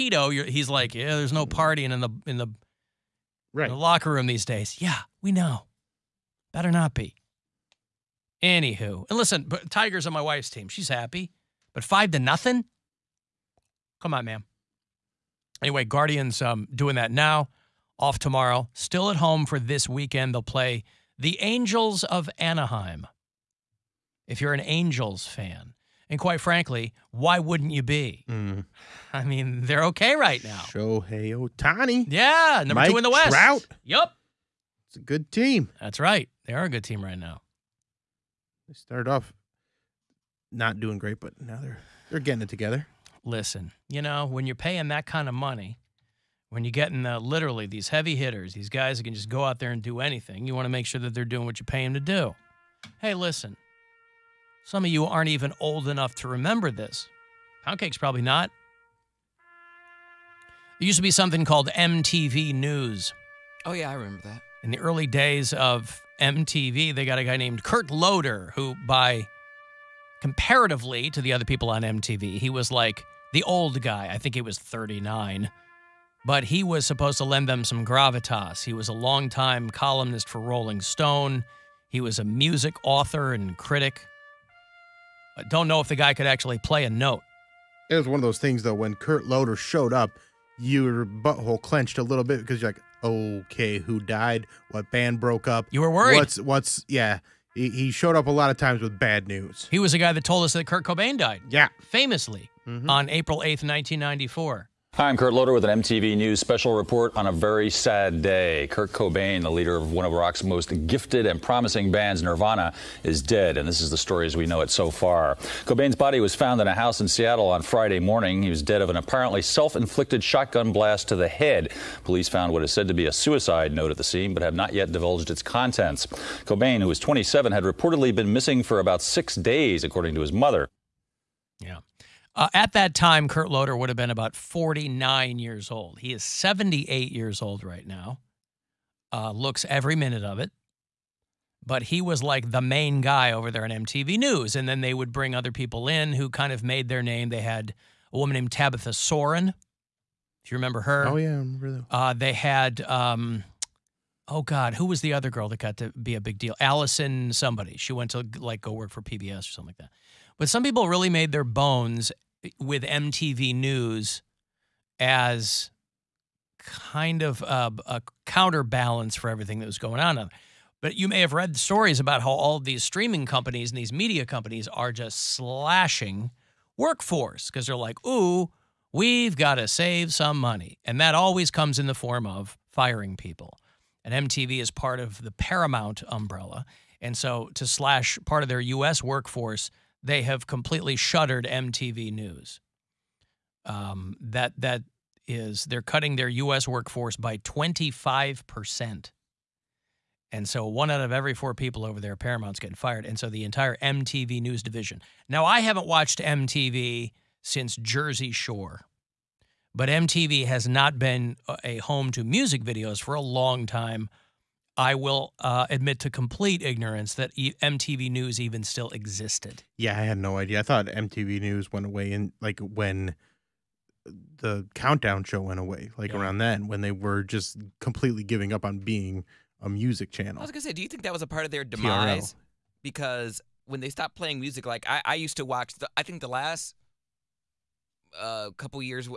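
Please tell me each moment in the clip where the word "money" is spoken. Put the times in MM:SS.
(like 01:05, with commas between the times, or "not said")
00:45, 03:00.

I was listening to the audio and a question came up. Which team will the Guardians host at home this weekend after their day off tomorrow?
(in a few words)
Angels of Anaheim.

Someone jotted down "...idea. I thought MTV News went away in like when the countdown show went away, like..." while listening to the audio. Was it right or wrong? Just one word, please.
right.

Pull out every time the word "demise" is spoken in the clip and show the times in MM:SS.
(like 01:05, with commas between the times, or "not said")
03:51.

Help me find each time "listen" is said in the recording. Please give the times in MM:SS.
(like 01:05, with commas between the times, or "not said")
00:09, 00:43, 00:53.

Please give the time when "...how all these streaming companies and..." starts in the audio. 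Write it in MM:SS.
02:52.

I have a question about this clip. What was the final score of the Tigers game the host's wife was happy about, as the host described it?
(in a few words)
5-0.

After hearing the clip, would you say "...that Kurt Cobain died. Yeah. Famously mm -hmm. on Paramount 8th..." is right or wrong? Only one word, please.
wrong.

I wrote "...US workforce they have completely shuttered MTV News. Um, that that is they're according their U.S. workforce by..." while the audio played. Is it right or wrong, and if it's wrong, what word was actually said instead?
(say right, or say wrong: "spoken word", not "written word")
wrong: "cutting", not "according".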